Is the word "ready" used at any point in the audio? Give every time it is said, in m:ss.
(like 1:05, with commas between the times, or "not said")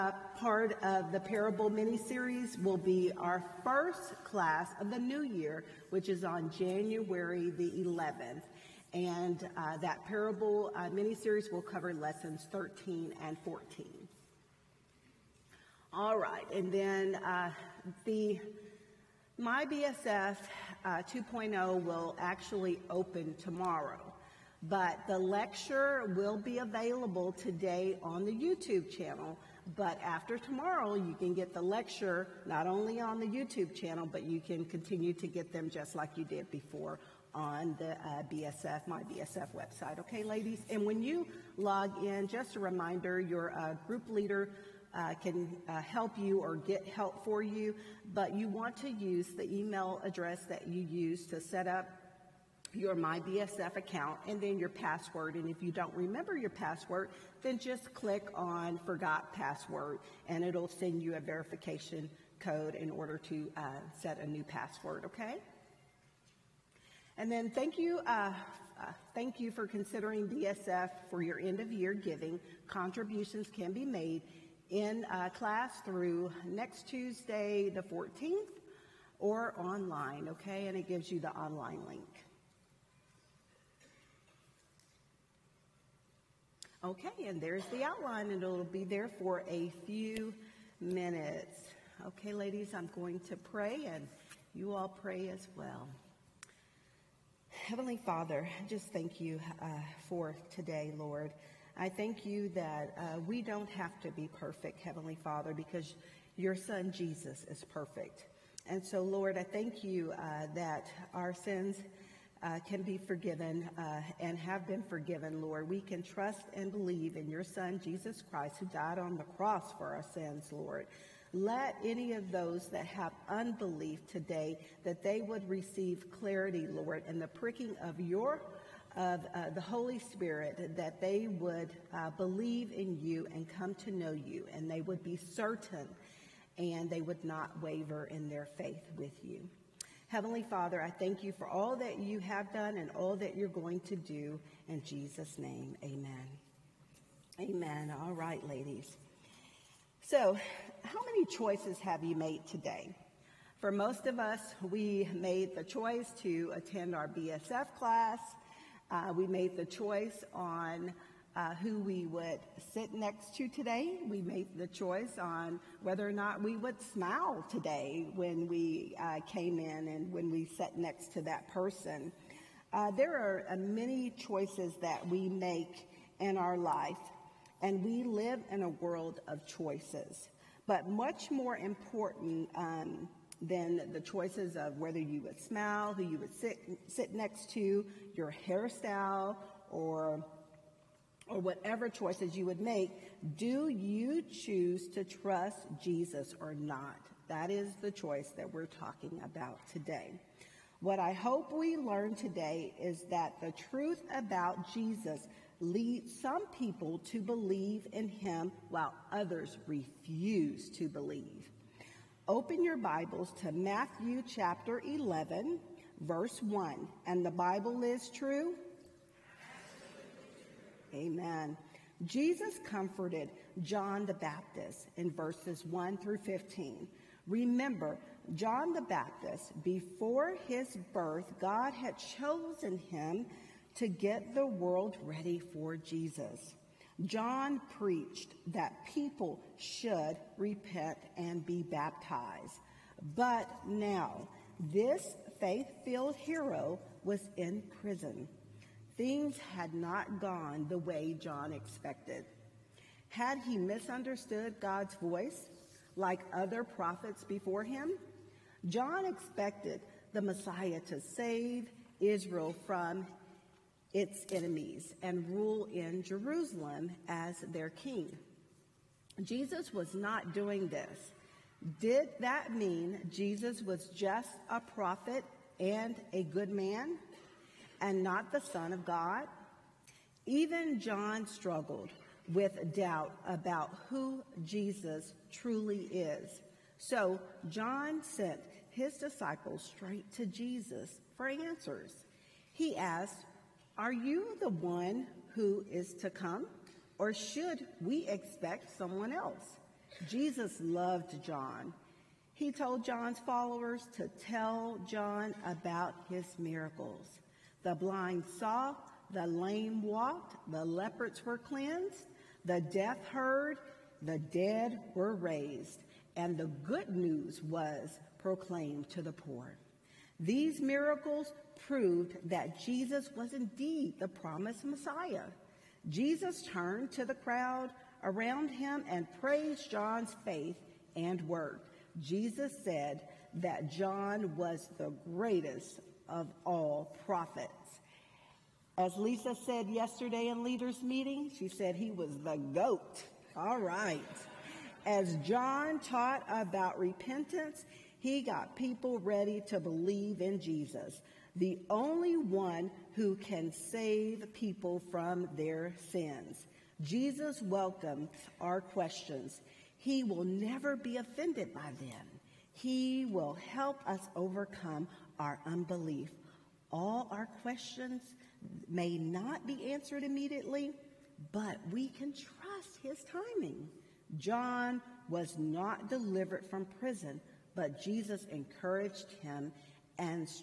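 3:55, 5:48.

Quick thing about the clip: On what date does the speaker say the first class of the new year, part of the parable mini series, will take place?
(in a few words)
January 11.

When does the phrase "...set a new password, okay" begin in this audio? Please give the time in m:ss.
1:04.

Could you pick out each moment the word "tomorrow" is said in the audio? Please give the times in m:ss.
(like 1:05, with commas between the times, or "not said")
0:23, 0:30.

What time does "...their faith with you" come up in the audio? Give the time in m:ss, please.
2:18.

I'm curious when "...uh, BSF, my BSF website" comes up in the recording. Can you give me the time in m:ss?
0:37.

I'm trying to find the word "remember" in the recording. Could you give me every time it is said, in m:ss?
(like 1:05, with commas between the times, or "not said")
0:55, 3:47.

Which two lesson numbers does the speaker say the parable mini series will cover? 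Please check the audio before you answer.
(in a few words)
13 and 14.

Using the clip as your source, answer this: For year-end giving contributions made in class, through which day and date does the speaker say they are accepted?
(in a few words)
Tuesday the 14th.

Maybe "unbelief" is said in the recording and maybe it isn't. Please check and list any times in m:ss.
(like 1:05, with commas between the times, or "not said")
2:03, 6:05.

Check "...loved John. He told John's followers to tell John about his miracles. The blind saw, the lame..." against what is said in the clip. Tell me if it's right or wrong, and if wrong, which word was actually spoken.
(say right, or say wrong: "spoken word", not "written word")
right.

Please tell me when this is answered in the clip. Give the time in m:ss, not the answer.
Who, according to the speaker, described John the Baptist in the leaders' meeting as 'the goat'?
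5:38.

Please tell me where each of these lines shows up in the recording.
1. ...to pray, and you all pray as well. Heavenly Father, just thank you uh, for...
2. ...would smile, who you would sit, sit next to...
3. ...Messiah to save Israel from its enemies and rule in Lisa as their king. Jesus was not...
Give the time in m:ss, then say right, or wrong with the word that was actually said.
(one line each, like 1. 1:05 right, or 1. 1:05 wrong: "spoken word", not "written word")
1. 1:33 right
2. 3:05 right
3. 4:20 wrong: "Jerusalem", not "Lisa".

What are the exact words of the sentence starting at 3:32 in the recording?
Open your Bibles to Matthew chapter 11, verse 1.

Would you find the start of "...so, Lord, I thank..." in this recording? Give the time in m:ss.
1:48.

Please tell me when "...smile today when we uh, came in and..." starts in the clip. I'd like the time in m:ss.
2:46.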